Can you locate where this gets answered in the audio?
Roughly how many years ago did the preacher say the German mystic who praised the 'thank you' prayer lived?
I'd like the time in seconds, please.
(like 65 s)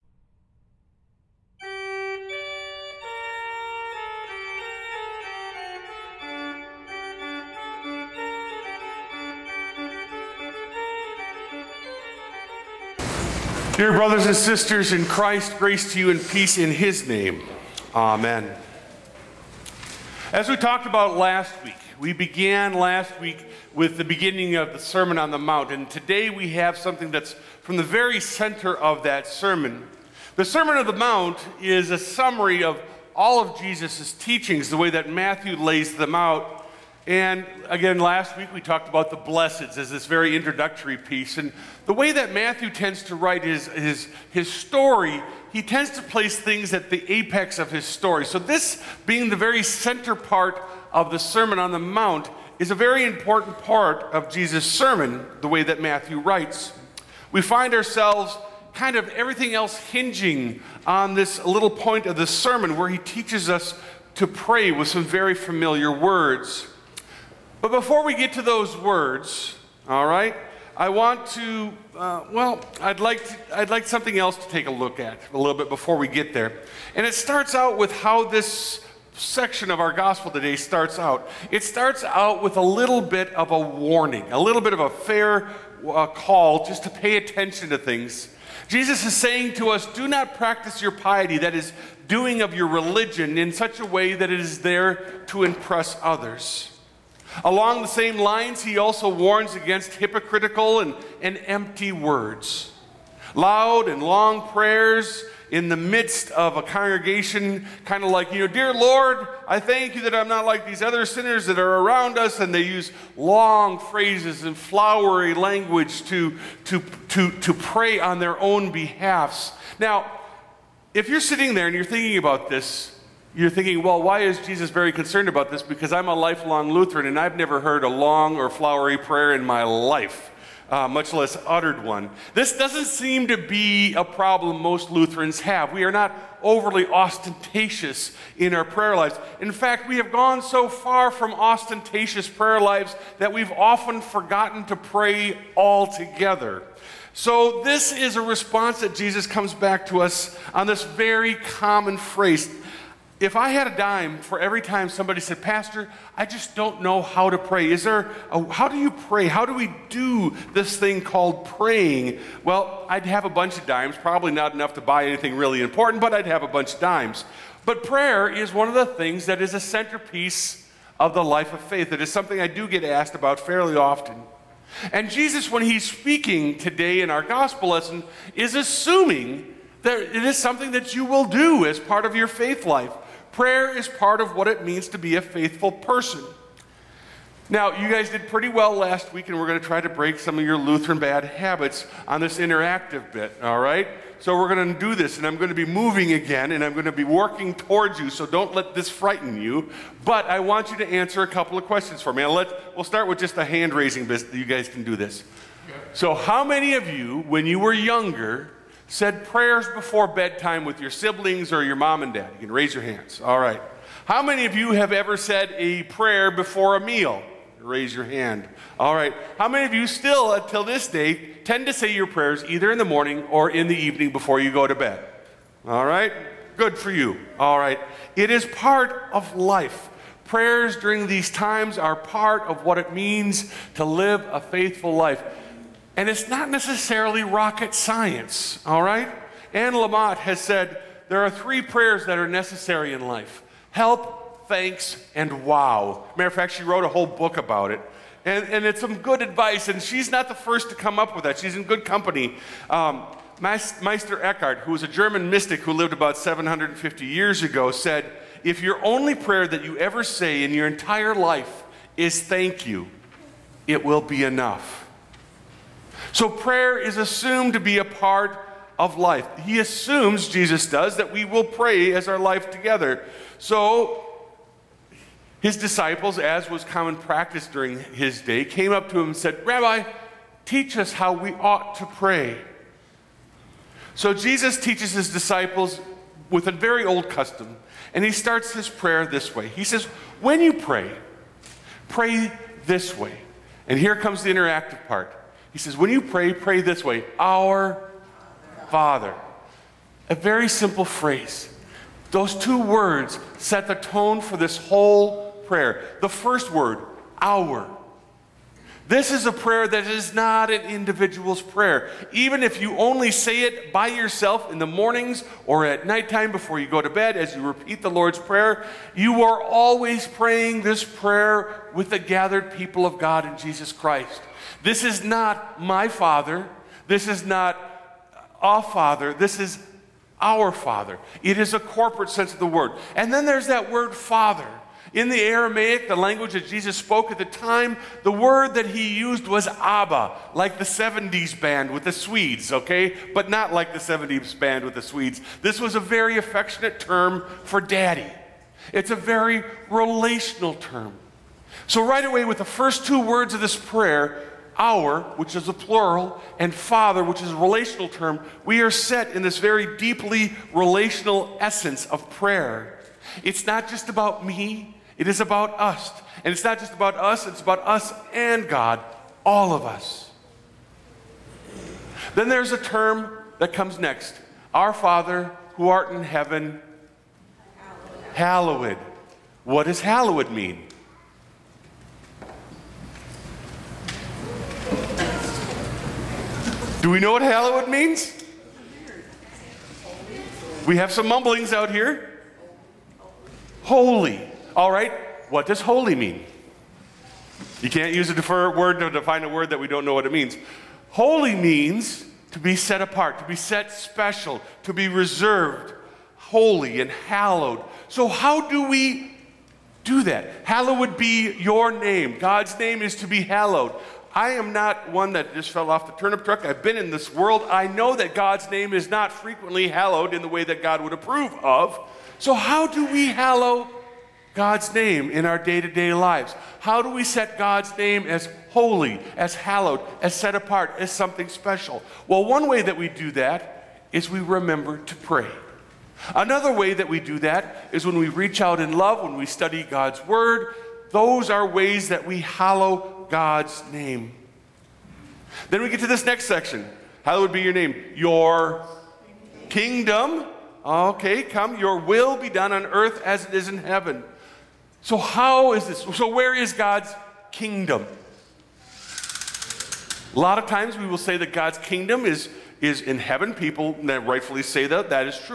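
256 s.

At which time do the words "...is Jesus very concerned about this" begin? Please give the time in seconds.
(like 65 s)
124 s.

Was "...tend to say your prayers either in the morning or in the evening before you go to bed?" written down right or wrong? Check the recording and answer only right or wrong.
right.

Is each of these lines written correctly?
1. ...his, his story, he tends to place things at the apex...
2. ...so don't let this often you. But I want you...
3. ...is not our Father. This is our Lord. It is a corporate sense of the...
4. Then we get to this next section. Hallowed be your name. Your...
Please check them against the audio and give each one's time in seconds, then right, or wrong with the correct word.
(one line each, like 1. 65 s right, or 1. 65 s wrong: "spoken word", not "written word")
1. 43 s right
2. 198 s wrong: "frighten", not "often"
3. 327 s wrong: "Father", not "Lord"
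4. 445 s right.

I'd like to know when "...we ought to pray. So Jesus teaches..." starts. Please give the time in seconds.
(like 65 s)
281 s.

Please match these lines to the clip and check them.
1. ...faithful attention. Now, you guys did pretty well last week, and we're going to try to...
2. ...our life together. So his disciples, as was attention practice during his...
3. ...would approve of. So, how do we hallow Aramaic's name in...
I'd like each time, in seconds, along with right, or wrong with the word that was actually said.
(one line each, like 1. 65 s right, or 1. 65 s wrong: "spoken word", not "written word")
1. 185 s wrong: "person", not "attention"
2. 272 s wrong: "common", not "attention"
3. 420 s wrong: "God", not "Aramaic".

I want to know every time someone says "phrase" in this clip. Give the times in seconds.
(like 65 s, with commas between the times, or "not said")
113 s, 151 s, 300 s.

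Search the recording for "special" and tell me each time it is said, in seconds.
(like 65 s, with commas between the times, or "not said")
403 s, 431 s.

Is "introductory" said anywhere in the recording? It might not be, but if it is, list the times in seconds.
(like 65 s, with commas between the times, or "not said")
40 s.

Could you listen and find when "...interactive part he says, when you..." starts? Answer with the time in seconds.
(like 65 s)
294 s.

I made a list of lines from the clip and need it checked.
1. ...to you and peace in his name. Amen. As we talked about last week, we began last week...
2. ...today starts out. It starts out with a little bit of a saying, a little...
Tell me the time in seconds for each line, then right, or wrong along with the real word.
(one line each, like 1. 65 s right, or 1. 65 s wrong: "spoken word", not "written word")
1. 15 s right
2. 80 s wrong: "warning", not "saying".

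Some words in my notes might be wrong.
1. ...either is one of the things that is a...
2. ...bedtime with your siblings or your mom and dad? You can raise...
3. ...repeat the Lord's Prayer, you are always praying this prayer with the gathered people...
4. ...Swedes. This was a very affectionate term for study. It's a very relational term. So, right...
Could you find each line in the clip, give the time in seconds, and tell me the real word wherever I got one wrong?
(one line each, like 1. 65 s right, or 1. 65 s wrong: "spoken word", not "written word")
1. 167 s wrong: "prayer", not "either"
2. 210 s right
3. 317 s right
4. 344 s wrong: "daddy", not "study".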